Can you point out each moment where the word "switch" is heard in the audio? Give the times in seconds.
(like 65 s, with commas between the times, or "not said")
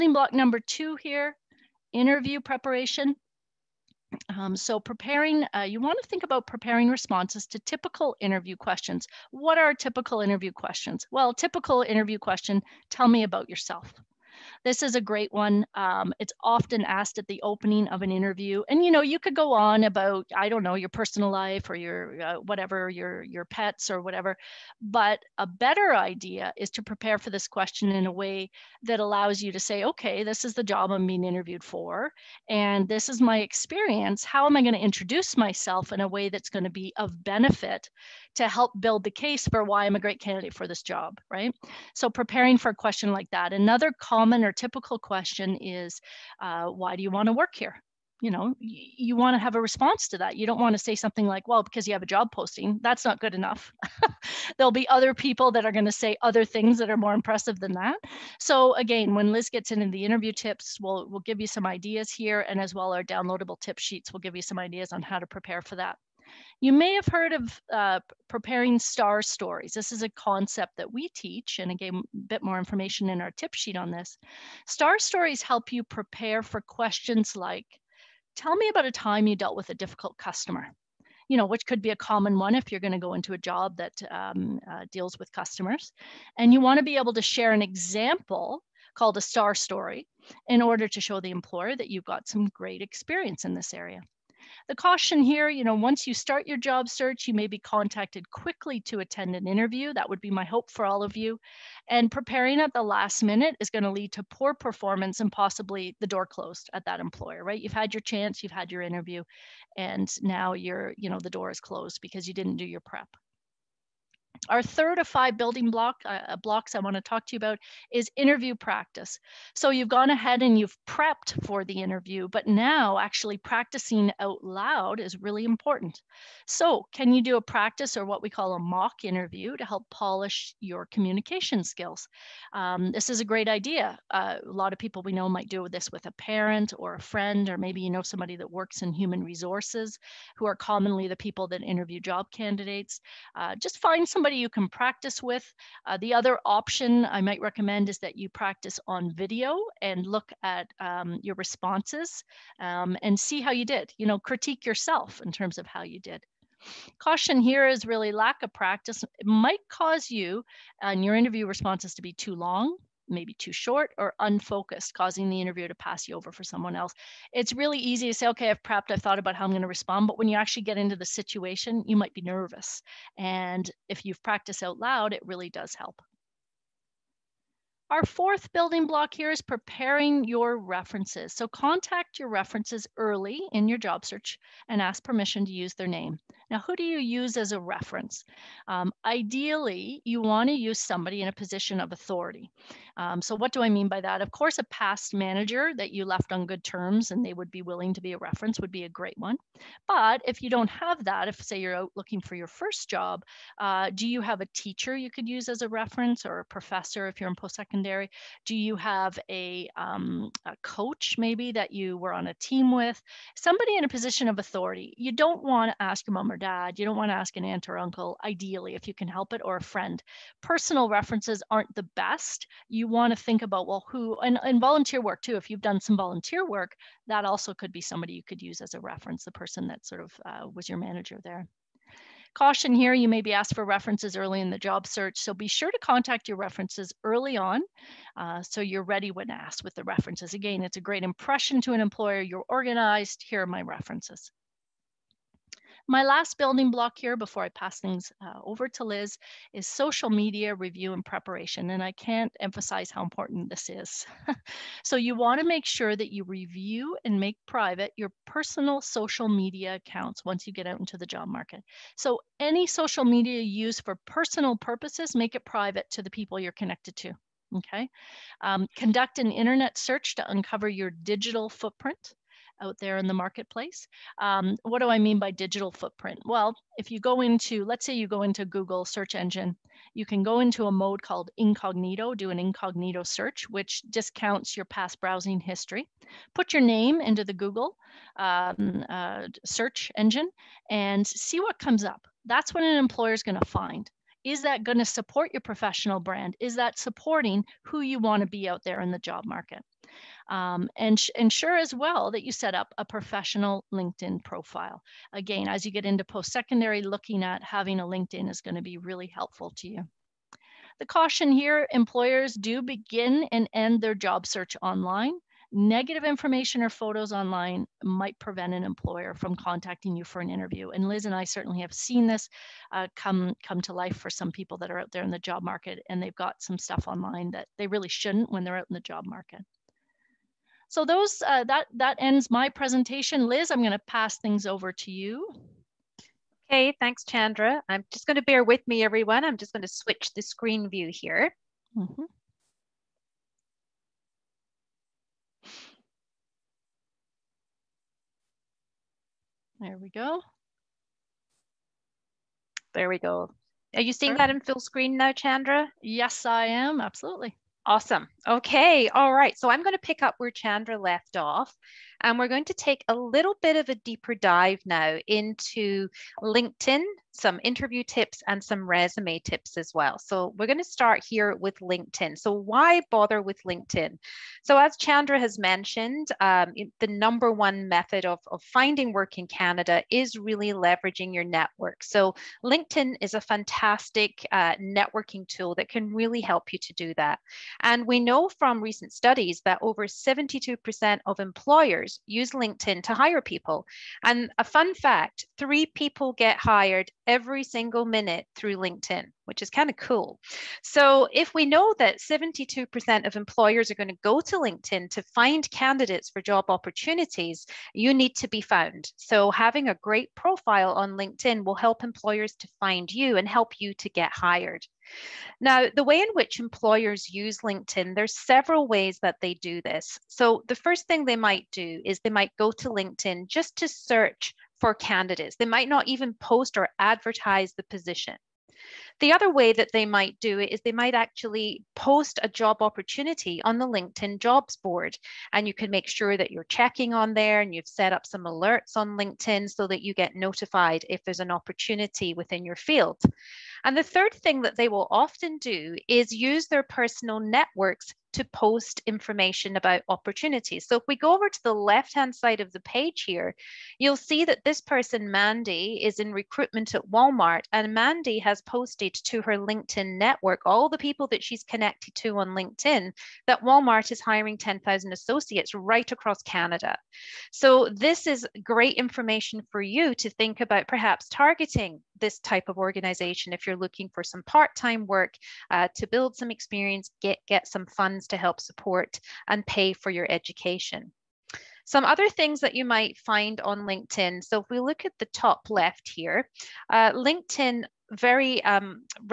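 339 s.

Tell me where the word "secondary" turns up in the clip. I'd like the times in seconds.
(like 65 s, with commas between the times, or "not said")
207 s, 306 s.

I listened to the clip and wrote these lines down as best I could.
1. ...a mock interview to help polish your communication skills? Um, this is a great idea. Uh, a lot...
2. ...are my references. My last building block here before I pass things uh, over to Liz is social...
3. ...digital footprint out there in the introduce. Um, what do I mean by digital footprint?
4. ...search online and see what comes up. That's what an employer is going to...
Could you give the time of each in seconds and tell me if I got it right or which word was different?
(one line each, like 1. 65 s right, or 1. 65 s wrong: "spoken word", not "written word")
1. 128 s right
2. 243 s right
3. 270 s wrong: "marketplace", not "introduce"
4. 289 s wrong: "engine", not "online".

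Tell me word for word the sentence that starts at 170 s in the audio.
But when you actually get into the situation, you might be nervous.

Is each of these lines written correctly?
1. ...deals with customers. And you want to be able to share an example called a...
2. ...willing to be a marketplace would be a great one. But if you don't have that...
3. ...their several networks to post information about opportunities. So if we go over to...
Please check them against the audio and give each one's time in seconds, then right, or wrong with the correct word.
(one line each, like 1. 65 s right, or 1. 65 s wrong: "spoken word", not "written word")
1. 84 s right
2. 197 s wrong: "reference", not "marketplace"
3. 446 s wrong: "personal", not "several".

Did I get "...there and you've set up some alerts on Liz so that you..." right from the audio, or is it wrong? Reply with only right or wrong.
wrong.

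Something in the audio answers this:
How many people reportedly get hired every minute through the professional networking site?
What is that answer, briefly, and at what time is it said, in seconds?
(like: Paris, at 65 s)
3, at 395 s.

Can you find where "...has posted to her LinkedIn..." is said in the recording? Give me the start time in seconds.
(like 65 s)
458 s.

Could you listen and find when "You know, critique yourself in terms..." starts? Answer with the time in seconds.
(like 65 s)
153 s.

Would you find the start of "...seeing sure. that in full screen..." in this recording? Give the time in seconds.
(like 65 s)
353 s.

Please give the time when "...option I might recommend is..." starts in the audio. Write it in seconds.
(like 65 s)
146 s.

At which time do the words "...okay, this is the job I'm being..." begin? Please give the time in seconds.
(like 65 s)
29 s.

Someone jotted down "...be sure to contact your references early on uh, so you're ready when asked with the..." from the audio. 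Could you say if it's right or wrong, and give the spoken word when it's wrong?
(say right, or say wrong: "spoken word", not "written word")
right.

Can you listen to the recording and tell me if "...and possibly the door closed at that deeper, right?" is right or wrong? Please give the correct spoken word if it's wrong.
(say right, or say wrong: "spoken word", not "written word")
wrong: "employer", not "deeper".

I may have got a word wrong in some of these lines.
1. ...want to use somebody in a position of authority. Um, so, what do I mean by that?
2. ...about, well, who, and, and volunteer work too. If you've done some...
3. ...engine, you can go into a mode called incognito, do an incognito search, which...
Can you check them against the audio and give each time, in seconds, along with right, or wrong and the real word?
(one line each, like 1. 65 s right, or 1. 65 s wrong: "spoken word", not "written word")
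1. 190 s right
2. 223 s right
3. 279 s right.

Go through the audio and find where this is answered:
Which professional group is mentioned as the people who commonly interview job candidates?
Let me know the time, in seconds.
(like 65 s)
138 s.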